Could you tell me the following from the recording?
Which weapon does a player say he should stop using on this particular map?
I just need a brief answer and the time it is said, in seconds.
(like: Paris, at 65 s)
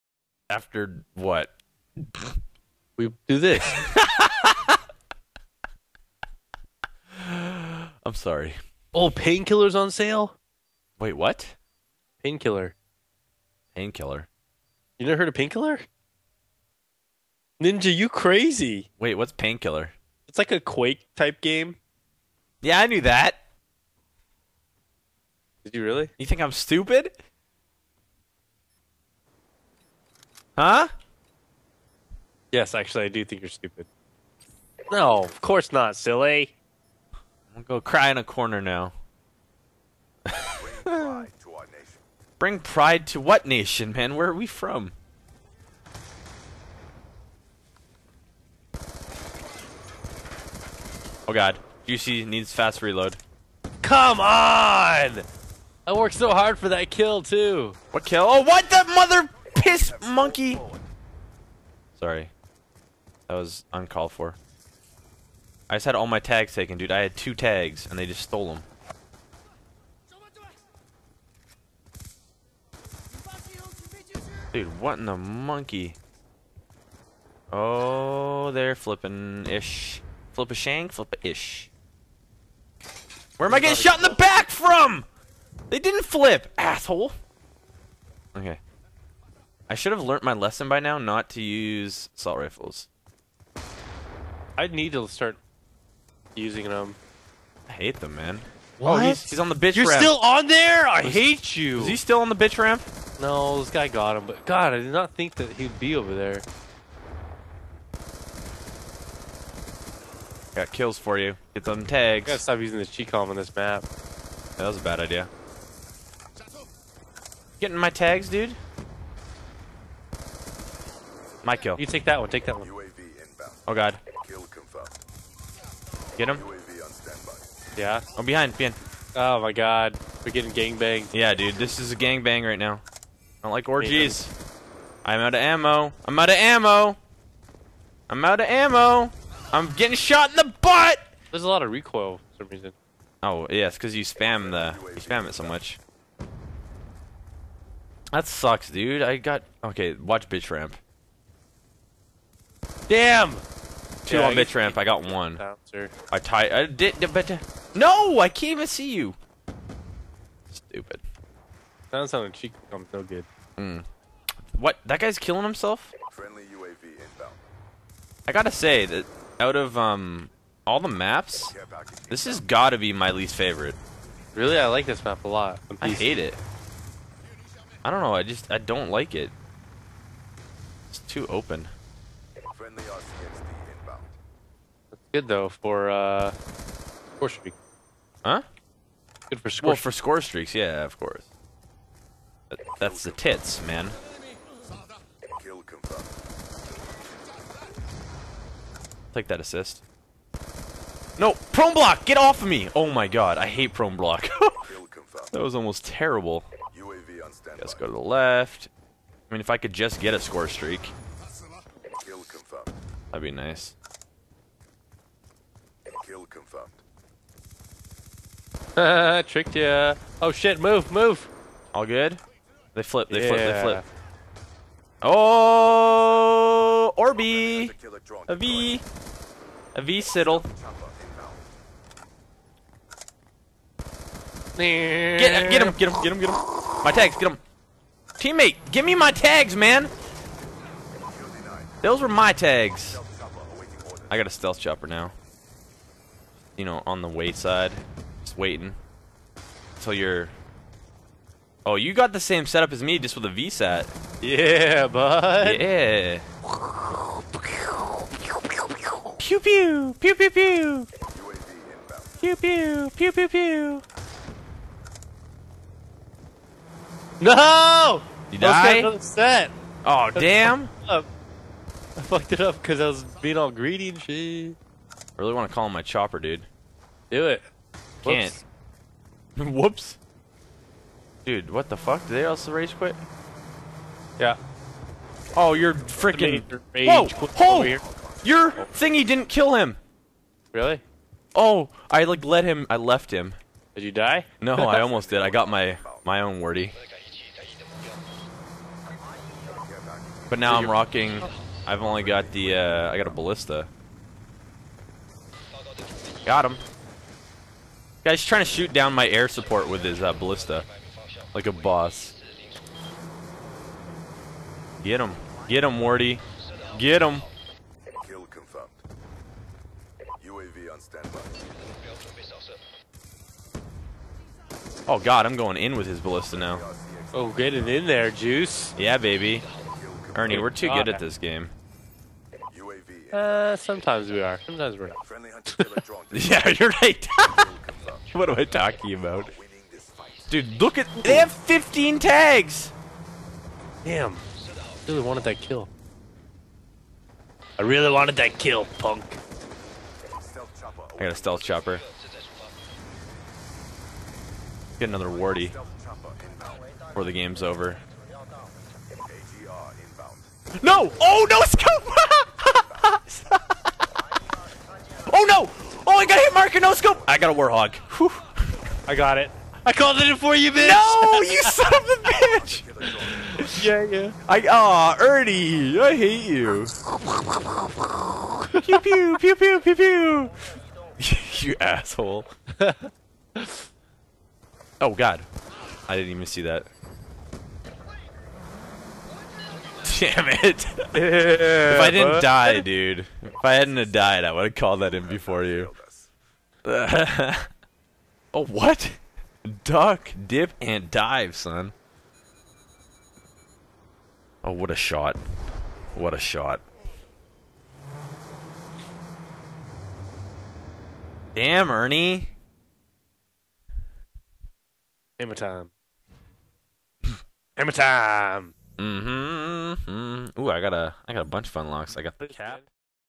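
Chicom, at 112 s.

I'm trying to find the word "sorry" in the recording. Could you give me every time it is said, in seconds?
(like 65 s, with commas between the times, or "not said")
8 s, 61 s.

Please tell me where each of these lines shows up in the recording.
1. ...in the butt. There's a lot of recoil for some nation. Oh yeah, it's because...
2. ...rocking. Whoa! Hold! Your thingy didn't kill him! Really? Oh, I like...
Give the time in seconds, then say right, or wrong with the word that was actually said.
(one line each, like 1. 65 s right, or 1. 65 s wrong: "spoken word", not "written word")
1. 140 s wrong: "reason", not "nation"
2. 285 s wrong: "freaking", not "rocking".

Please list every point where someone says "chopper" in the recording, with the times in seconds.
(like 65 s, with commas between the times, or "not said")
244 s, 275 s, 351 s.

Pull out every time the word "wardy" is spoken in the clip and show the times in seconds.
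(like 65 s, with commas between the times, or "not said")
315 s, 355 s.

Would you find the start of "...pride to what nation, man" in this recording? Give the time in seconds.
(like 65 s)
42 s.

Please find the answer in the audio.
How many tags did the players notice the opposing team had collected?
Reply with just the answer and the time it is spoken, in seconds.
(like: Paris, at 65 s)
15, at 341 s.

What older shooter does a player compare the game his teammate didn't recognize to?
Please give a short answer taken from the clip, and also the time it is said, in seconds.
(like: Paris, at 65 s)
Quake, at 20 s.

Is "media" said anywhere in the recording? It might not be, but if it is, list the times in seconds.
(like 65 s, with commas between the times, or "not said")
not said.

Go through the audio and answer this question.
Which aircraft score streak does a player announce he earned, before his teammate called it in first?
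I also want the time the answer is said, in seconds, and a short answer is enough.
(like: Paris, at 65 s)
Warthog, at 367 s.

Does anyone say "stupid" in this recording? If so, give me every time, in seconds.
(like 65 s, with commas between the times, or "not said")
26 s, 33 s, 160 s.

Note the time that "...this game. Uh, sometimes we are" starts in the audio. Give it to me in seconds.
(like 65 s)
330 s.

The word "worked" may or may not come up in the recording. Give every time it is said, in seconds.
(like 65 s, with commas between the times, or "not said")
55 s.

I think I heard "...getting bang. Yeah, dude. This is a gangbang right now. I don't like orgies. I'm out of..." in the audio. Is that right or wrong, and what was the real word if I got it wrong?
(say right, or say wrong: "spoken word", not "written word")
right.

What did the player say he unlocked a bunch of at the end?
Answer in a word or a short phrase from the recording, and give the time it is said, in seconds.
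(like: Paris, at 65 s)
Unlocks, at 421 s.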